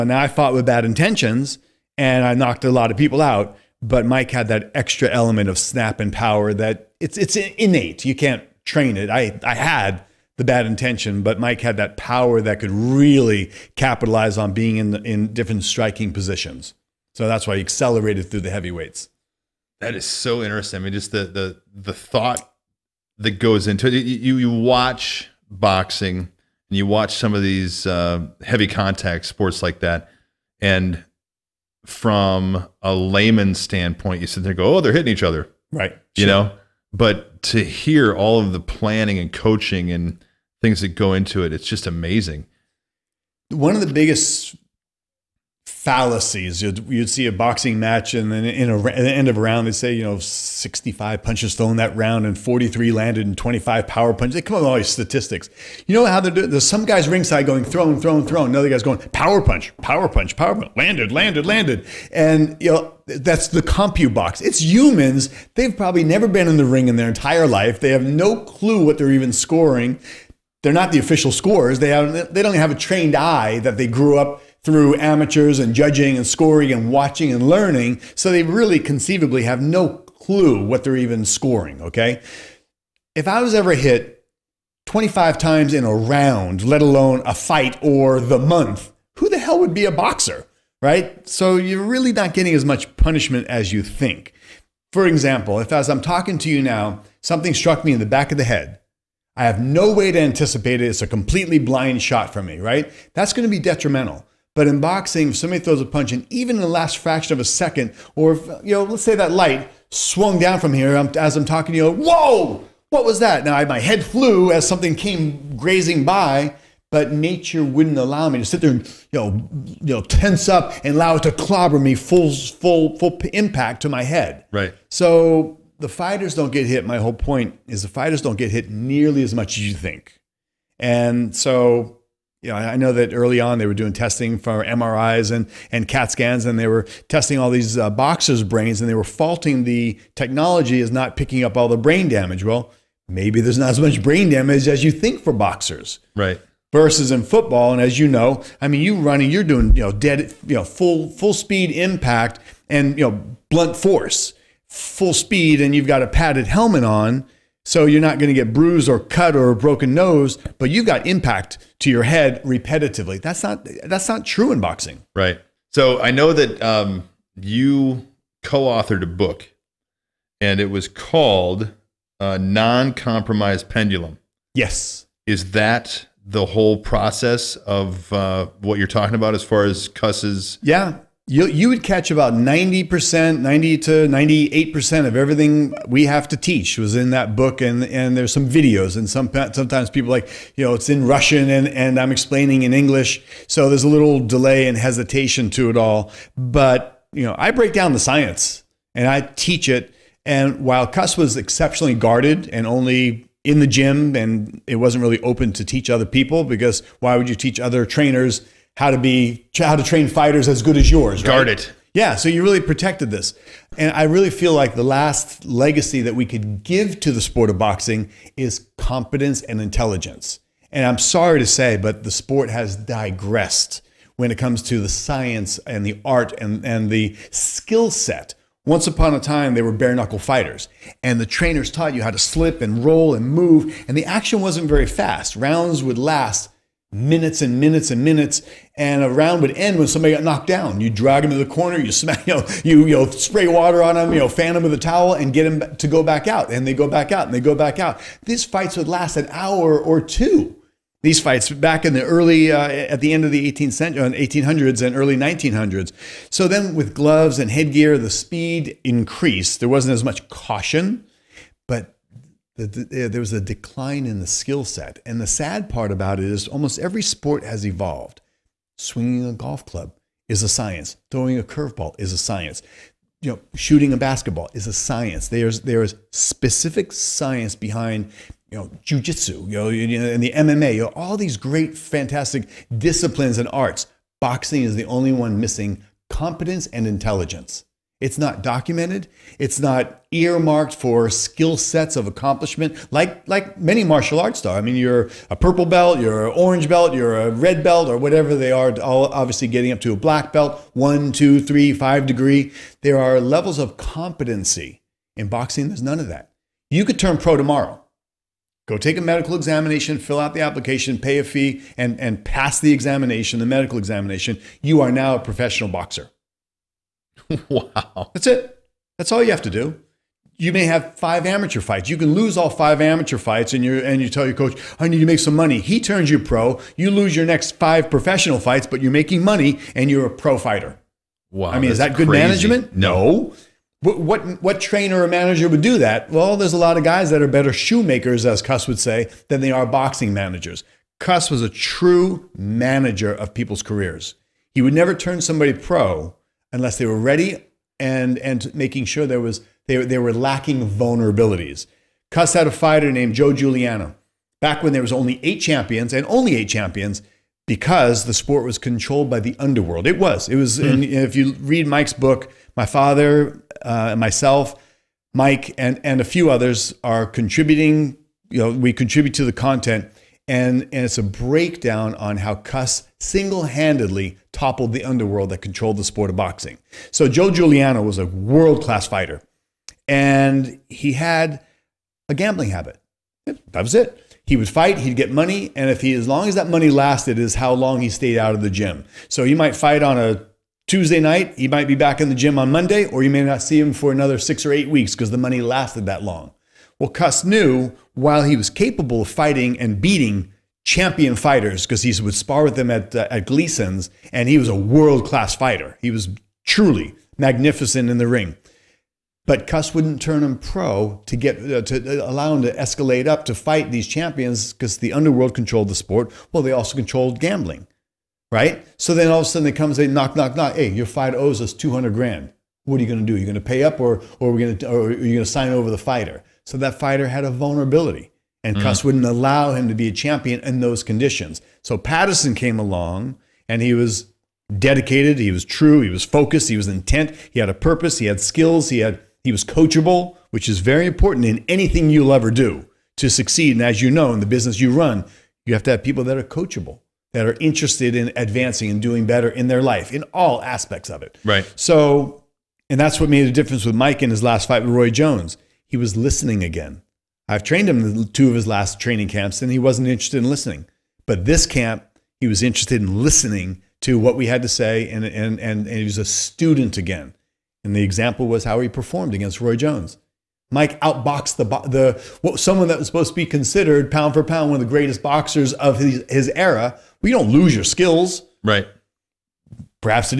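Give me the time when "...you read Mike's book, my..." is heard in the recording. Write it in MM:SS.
06:01.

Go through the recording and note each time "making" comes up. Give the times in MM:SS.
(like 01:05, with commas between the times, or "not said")
05:28, 05:48.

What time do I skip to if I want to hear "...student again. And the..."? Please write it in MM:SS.
07:46.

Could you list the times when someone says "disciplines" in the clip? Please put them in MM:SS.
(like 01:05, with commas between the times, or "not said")
04:42.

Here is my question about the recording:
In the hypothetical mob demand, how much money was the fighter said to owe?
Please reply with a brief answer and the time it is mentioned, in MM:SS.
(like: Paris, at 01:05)
$200,000, at 07:01.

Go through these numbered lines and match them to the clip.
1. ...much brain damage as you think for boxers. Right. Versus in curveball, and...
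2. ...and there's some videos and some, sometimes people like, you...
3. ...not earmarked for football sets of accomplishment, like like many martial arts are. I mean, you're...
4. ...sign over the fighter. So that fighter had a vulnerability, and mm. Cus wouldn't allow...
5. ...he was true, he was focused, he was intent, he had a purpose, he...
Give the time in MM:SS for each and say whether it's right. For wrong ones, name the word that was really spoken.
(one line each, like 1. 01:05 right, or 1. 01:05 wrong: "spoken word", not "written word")
1. 02:23 wrong: "football", not "curveball"
2. 03:07 right
3. 04:49 wrong: "skill", not "football"
4. 07:05 right
5. 07:15 right.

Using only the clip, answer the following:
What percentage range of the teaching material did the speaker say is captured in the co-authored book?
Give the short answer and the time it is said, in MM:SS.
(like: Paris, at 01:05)
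90 to 98%, at 03:03.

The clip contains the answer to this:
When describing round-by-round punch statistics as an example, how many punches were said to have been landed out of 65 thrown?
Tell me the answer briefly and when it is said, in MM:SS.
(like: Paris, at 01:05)
43, at 00:52.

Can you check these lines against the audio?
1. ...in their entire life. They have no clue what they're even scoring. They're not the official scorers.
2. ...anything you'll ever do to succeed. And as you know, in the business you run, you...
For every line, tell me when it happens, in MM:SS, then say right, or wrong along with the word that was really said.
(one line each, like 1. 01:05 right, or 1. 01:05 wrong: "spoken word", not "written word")
1. 01:06 right
2. 07:21 right.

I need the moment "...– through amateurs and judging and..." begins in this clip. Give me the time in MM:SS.
01:14.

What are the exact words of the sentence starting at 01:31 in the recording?
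So you're really not getting as much punishment as you think.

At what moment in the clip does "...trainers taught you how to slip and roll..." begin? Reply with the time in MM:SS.
03:51.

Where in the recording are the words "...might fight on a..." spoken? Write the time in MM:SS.
06:29.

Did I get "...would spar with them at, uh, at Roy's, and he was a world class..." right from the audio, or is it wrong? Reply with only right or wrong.
wrong.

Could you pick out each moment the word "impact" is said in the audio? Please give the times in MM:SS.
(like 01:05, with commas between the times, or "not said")
02:03, 02:31, 02:41.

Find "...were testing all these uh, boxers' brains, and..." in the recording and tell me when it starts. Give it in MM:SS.
02:16.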